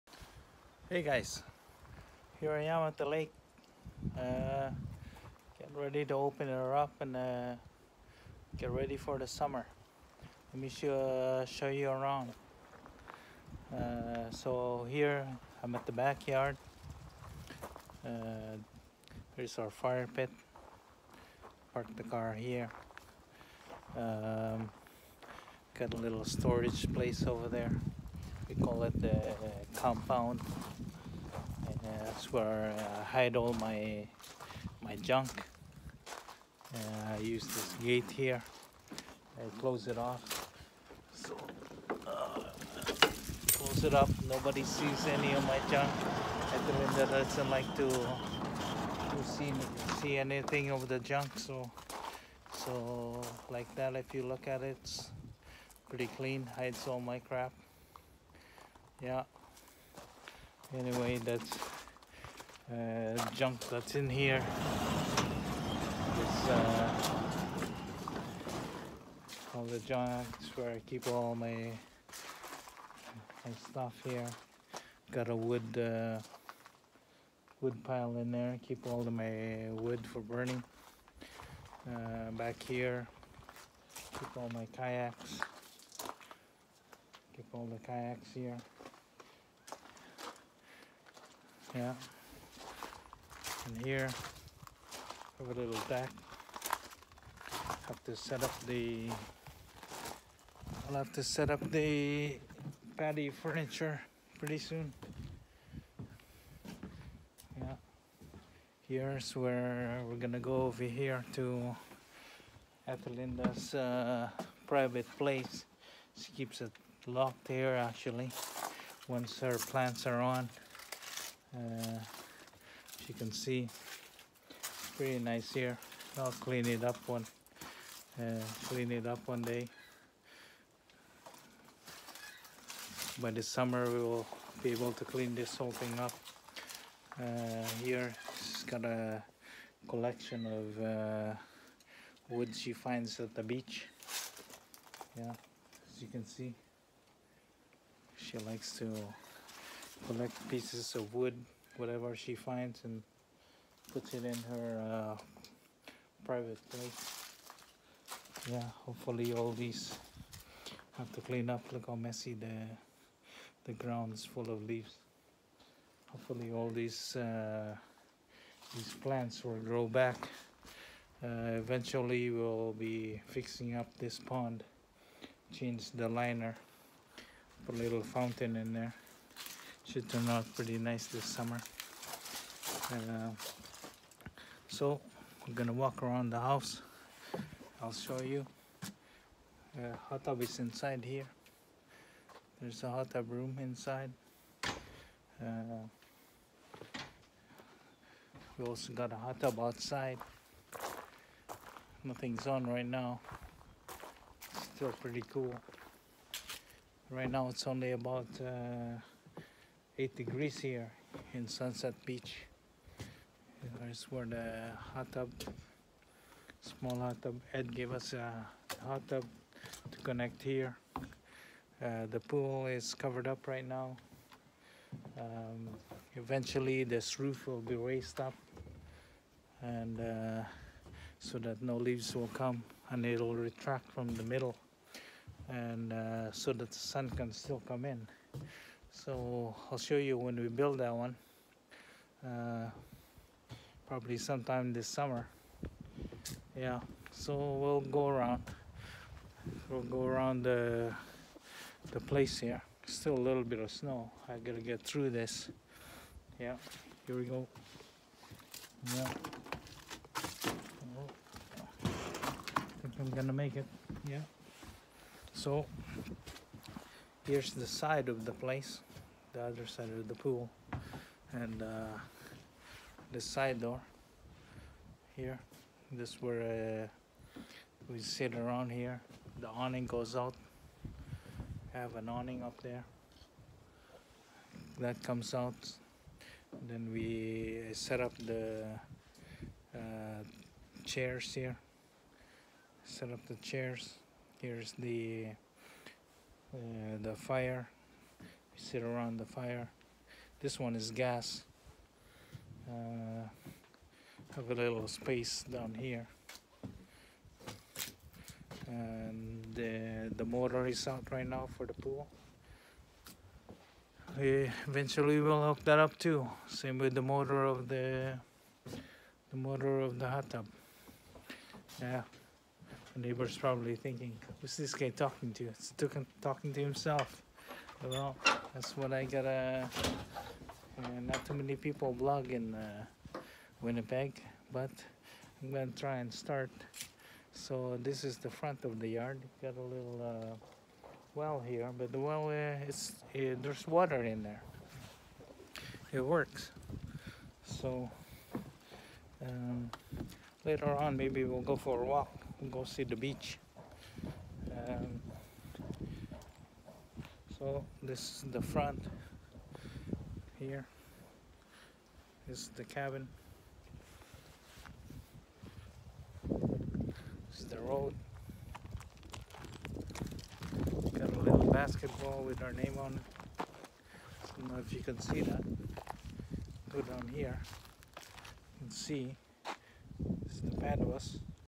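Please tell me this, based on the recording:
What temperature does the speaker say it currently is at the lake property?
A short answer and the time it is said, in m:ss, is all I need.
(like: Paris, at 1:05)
8 degrees, at 3:30.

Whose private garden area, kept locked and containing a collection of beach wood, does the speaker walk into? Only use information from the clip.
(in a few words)
Ethelinda.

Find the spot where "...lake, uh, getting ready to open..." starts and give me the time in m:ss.
0:03.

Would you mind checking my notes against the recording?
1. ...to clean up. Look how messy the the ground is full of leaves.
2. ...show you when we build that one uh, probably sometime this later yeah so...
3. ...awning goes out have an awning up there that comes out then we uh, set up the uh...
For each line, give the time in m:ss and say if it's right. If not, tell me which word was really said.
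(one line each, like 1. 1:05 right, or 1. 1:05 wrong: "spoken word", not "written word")
1. 2:41 right
2. 3:59 wrong: "summer", not "later"
3. 4:39 right.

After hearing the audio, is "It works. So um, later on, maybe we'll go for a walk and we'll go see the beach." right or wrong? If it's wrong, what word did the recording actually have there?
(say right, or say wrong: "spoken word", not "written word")
right.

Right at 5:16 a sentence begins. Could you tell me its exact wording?
Same with the motor of the the motor of the hot tub.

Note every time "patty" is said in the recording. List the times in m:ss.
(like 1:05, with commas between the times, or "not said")
1:42.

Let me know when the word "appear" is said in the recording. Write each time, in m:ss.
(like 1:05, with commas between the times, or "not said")
not said.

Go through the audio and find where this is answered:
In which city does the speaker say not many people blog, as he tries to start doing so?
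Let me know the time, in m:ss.
5:33.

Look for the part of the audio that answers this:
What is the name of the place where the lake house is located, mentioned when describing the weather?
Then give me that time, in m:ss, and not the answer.
3:31.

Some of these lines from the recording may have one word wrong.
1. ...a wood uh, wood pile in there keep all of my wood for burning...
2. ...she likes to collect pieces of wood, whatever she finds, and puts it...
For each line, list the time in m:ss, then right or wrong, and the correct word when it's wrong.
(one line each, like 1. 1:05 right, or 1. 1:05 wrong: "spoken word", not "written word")
1. 1:15 right
2. 2:28 right.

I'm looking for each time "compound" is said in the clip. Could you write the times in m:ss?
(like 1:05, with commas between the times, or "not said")
0:29.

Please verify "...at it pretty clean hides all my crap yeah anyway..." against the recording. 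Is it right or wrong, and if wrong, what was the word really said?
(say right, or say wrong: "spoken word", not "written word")
right.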